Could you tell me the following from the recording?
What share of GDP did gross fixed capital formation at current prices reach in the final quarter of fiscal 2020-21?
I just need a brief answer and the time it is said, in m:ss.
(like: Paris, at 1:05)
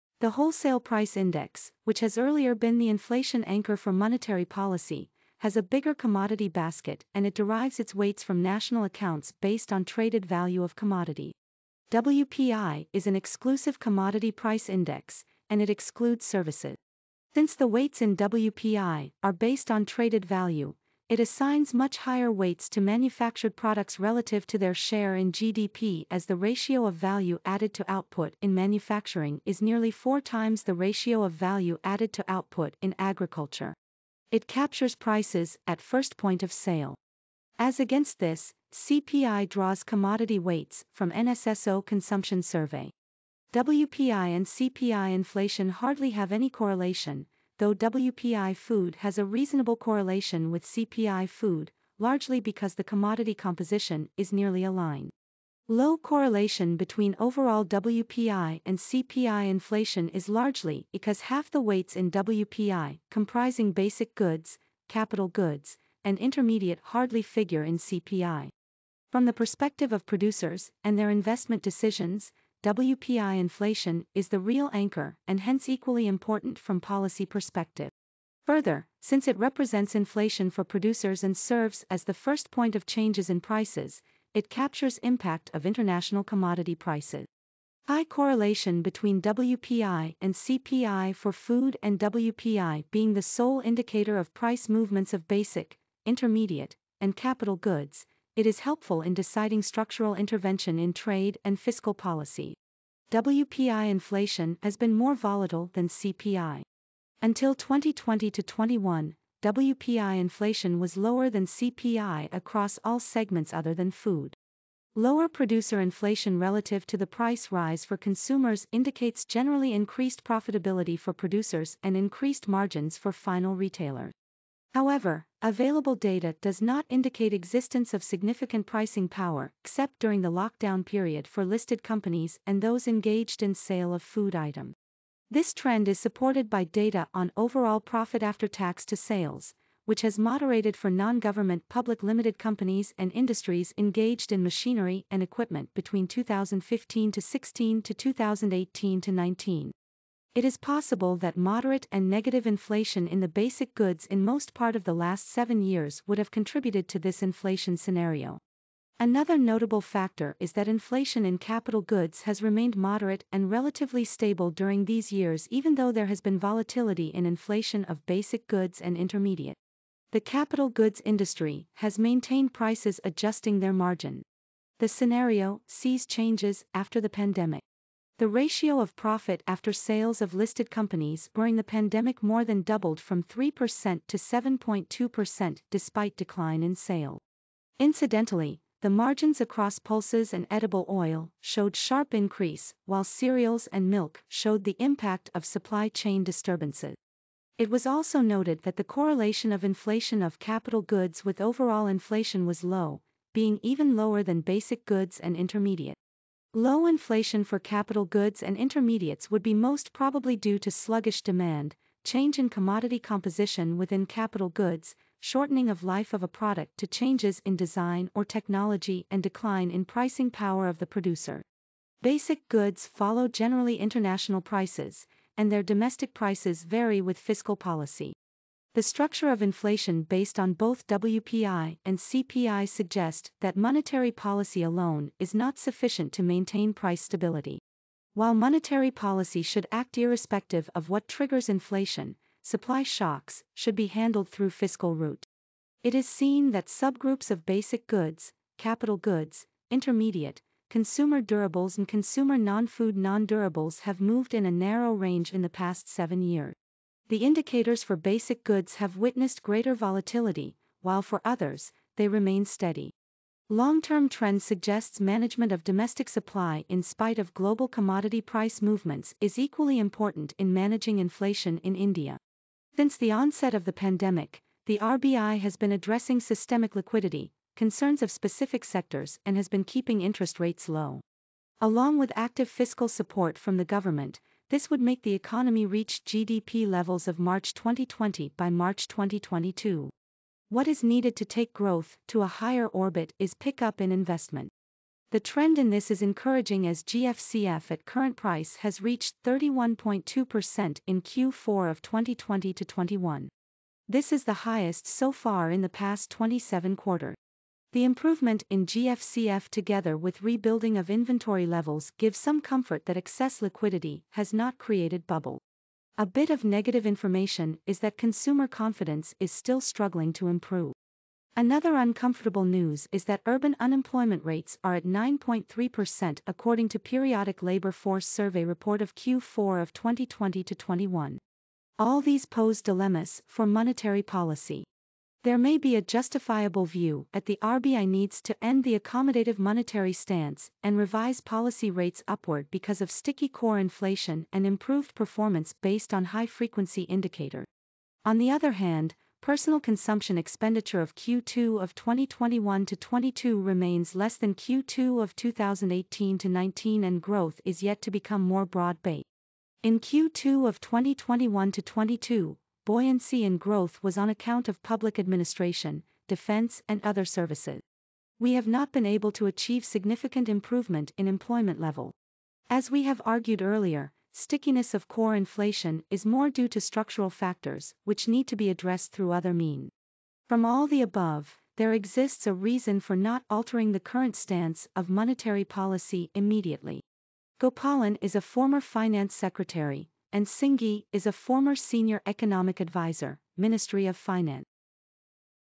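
31.2%, at 4:59.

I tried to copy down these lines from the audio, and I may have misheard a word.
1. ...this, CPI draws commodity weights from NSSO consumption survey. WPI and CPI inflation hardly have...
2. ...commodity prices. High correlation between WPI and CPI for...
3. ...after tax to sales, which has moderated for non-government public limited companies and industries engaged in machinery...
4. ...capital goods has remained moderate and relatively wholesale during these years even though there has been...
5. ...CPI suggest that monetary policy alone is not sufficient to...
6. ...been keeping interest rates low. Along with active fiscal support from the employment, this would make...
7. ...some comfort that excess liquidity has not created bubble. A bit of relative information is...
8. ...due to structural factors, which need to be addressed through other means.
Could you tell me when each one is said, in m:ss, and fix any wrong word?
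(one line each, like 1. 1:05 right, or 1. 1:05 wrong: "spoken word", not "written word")
1. 0:38 right
2. 1:26 right
3. 2:18 right
4. 2:41 wrong: "stable", not "wholesale"
5. 3:51 right
6. 4:39 wrong: "government", not "employment"
7. 5:12 wrong: "negative", not "relative"
8. 6:16 right.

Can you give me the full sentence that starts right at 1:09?
From the perspective of producers and their investment decisions, WPI inflation is the real anchor and hence equally important from policy perspective.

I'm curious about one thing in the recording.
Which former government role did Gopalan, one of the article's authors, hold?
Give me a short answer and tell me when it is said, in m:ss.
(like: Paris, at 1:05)
Finance secretary, at 6:28.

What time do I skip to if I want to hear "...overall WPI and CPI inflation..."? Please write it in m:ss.
0:57.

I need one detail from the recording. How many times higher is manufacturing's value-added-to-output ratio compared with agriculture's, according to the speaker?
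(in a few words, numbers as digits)
4.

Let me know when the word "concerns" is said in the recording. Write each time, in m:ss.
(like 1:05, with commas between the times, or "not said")
4:37.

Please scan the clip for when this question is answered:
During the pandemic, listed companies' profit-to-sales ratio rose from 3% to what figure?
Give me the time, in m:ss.
3:04.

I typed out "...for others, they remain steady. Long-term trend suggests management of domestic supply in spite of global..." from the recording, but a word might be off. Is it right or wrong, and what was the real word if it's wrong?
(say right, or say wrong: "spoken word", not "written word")
right.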